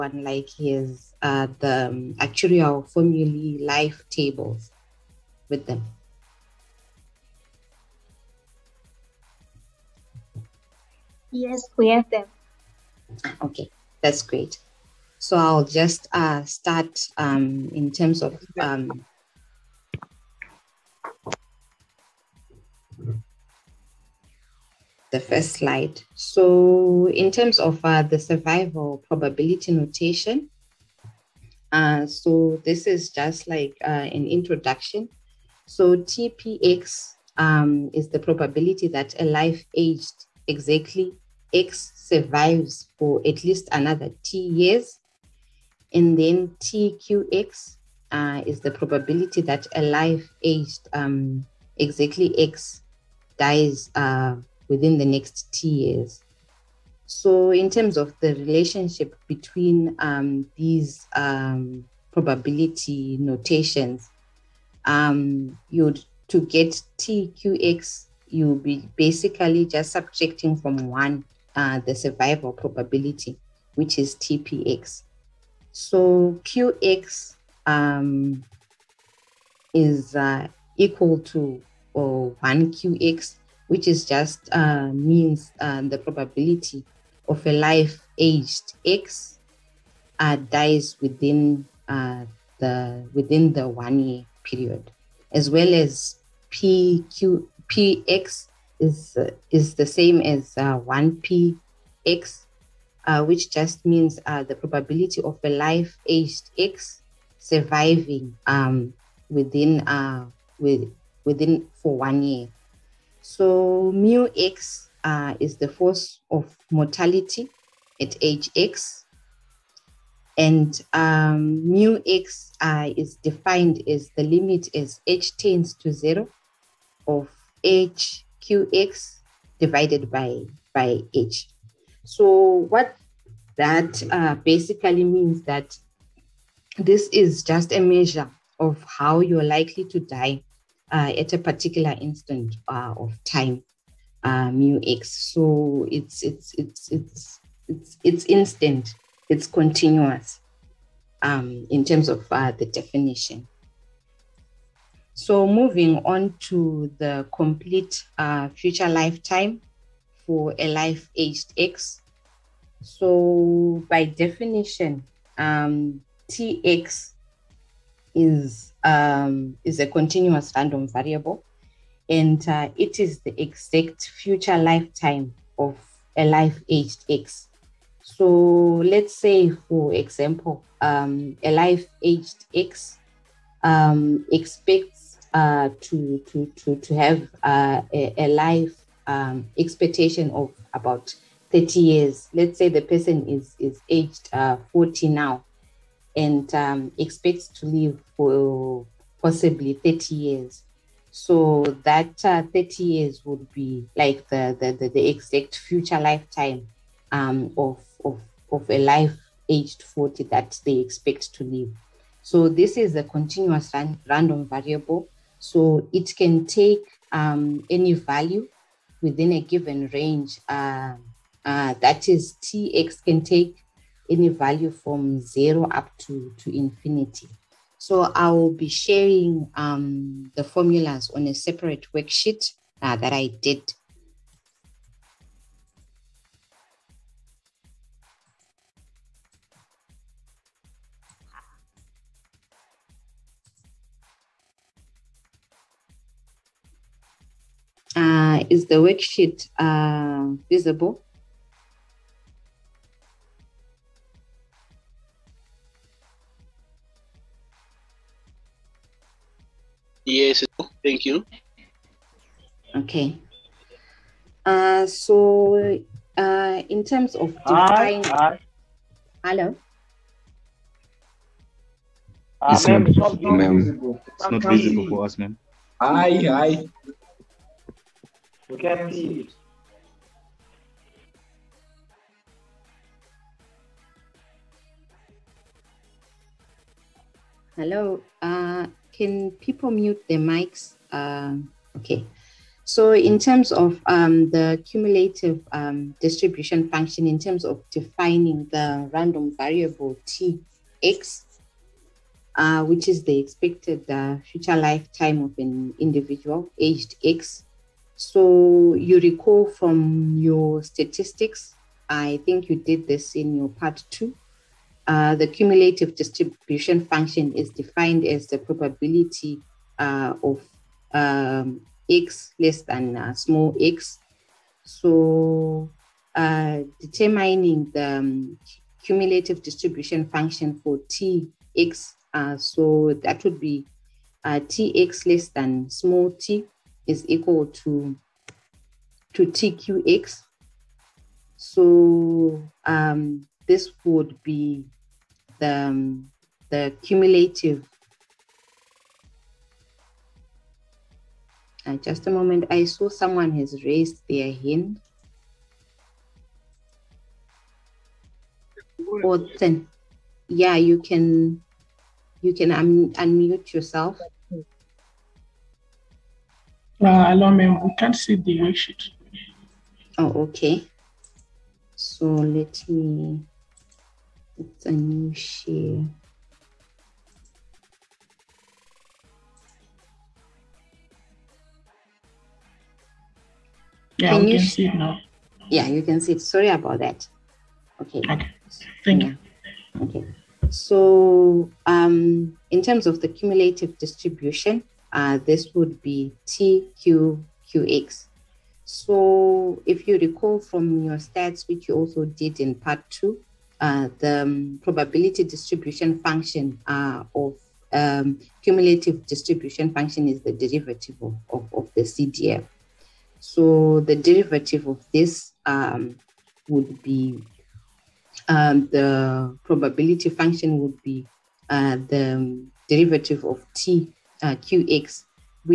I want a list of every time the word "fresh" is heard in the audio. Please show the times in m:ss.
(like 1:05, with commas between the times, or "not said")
not said.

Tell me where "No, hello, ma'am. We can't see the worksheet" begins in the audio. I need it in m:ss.
6:06.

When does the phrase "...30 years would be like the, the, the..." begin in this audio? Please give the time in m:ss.
3:22.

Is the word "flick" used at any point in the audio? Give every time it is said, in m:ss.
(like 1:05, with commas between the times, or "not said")
not said.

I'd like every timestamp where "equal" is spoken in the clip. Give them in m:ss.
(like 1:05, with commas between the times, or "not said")
1:20, 5:37.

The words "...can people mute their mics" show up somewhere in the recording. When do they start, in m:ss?
4:48.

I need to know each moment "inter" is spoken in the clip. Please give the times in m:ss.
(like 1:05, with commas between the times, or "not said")
not said.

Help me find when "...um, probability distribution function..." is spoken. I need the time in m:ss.
6:44.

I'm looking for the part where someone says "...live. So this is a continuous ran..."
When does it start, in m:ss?
3:31.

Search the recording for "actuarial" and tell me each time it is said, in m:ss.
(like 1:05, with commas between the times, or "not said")
0:02.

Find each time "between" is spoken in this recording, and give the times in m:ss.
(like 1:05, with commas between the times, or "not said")
0:59.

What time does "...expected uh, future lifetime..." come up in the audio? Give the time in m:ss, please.
5:03.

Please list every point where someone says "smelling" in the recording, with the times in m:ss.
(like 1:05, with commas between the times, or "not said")
not said.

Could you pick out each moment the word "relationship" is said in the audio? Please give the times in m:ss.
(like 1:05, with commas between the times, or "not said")
0:58.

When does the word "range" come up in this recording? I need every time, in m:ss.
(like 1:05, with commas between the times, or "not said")
3:39.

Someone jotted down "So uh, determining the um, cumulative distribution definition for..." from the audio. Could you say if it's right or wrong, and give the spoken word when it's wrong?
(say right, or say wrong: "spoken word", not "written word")
wrong: "function", not "definition".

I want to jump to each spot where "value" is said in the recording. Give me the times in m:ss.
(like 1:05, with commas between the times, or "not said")
3:37, 3:44.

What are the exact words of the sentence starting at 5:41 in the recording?
So um, this would be the, um, the cumulative.